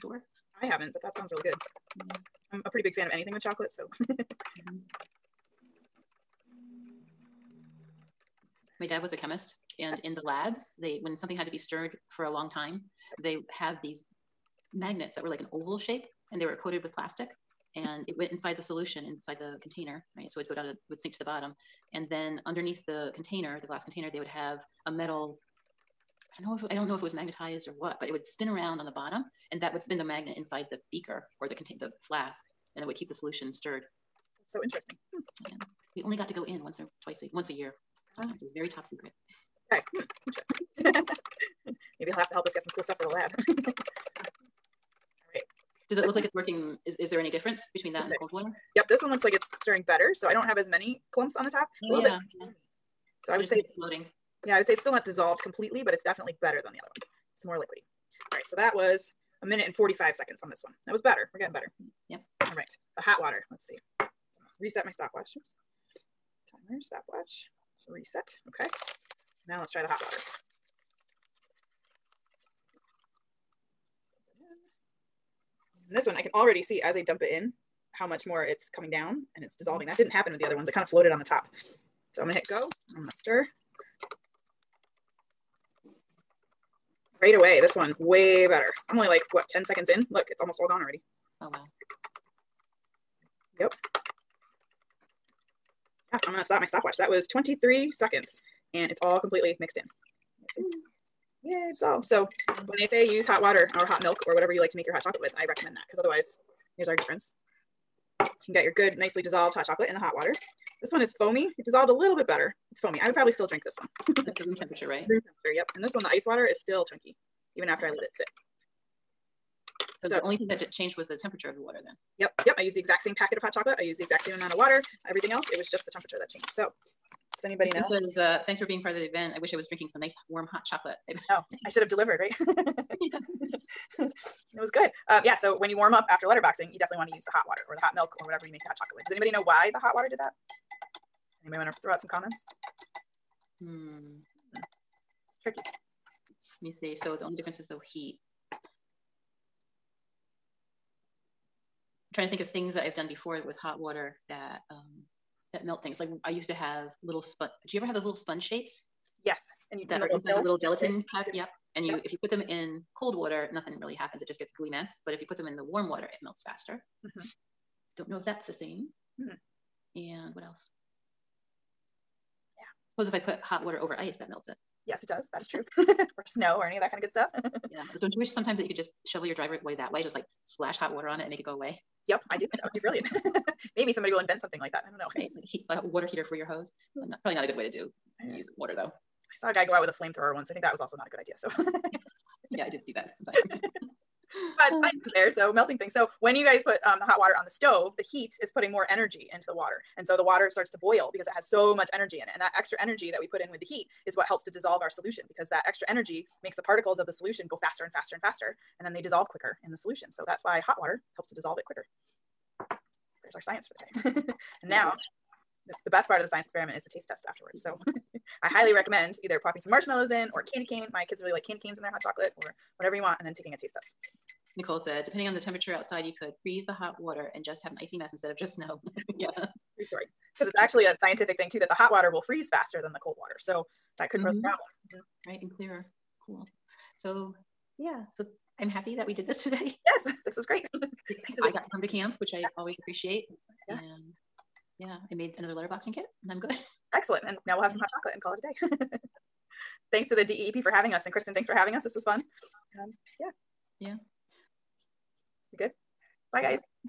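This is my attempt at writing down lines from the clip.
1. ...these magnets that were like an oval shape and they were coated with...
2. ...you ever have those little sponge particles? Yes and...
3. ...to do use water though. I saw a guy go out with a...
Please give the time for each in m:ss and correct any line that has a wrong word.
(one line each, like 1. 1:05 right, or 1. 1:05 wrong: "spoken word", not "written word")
1. 0:13 right
2. 2:37 wrong: "shapes", not "particles"
3. 3:07 right.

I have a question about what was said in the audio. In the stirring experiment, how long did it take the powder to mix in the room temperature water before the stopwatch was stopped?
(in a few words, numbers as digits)
1 minute 45 seconds.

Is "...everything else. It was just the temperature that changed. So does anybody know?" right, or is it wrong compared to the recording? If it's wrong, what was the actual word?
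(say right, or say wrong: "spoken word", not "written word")
right.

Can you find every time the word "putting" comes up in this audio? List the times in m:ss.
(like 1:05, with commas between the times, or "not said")
3:18.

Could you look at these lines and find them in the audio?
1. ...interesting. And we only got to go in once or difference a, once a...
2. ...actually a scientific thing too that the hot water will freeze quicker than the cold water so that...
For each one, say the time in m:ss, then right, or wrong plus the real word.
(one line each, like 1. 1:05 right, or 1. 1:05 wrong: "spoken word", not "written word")
1. 0:34 wrong: "twice", not "difference"
2. 3:50 wrong: "faster", not "quicker".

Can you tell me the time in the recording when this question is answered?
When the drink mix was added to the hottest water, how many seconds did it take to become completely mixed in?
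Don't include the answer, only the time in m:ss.
1:37.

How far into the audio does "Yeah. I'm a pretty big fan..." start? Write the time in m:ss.
0:01.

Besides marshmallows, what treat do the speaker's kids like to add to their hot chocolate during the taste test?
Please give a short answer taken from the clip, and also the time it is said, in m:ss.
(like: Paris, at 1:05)
Candy canes, at 3:41.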